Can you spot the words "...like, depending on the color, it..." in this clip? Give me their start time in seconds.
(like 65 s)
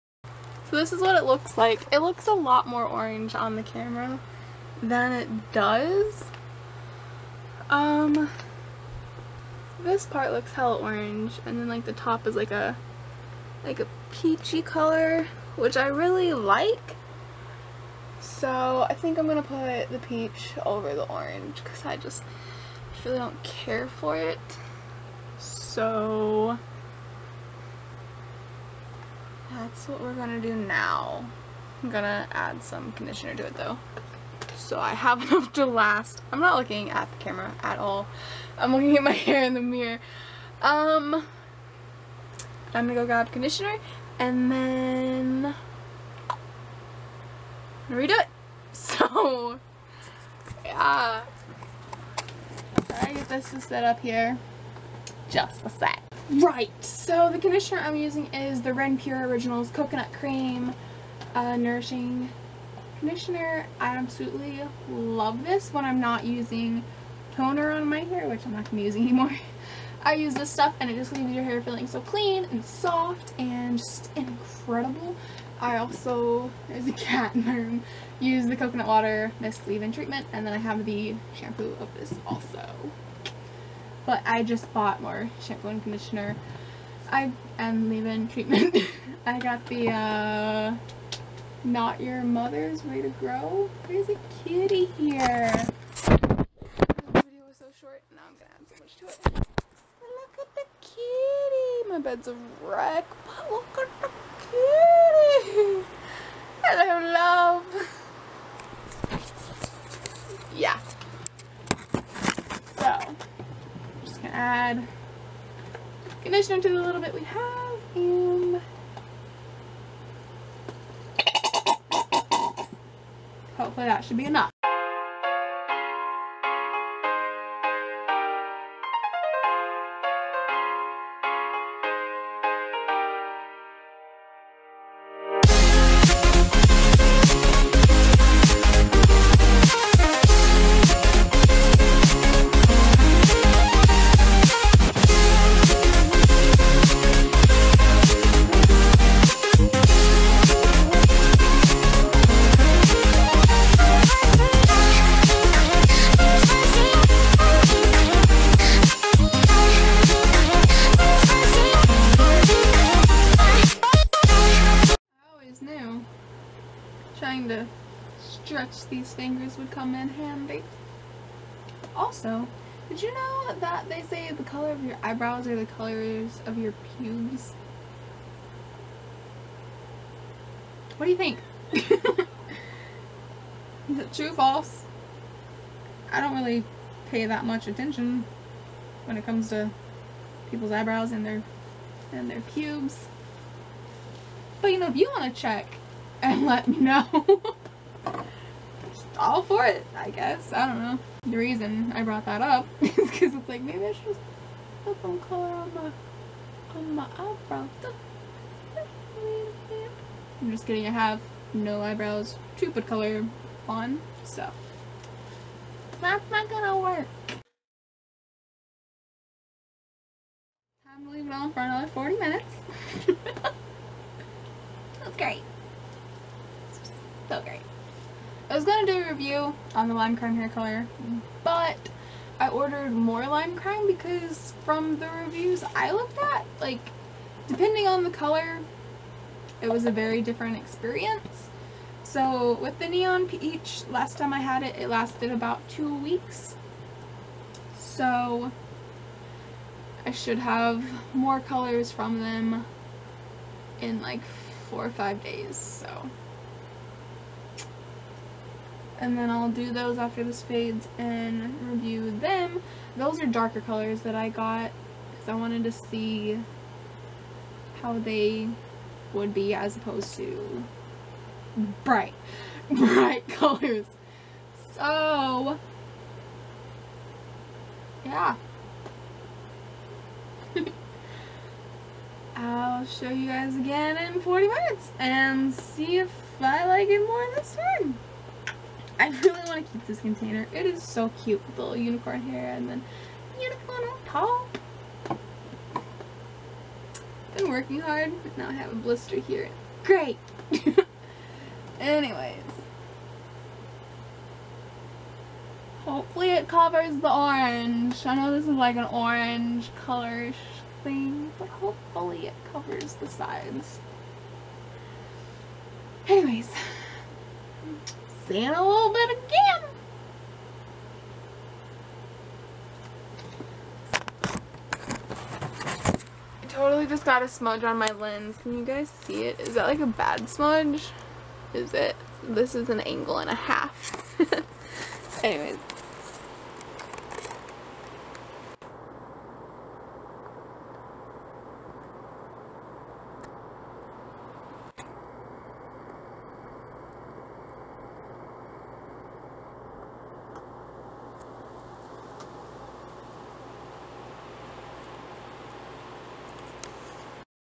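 236 s.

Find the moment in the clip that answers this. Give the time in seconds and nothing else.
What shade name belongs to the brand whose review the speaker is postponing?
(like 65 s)
242 s.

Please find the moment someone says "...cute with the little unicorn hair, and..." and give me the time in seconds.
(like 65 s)
291 s.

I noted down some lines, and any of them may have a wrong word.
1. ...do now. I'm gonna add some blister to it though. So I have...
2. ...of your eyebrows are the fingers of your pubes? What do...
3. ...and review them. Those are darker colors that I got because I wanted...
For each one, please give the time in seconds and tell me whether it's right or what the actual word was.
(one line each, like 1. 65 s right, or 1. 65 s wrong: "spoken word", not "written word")
1. 30 s wrong: "conditioner", not "blister"
2. 174 s wrong: "colors", not "fingers"
3. 260 s right.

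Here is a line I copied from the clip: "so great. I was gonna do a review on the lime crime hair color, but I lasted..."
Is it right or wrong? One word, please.
wrong.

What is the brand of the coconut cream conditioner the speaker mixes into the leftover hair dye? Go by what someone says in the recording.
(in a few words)
Renpure.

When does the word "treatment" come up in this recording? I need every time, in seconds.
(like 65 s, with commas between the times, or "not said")
79 s, 88 s.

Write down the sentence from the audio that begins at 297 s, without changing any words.
Been working hard, but now I have a blister here.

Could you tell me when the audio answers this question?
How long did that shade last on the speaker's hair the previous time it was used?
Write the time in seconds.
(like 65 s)
245 s.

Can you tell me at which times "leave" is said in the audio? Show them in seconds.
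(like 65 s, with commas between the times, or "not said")
71 s, 79 s, 87 s, 221 s.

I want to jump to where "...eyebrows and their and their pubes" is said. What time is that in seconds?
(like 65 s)
190 s.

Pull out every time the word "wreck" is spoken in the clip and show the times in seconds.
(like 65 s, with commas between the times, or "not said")
102 s.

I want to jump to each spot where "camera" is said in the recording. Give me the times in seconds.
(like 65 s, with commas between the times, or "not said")
3 s, 37 s.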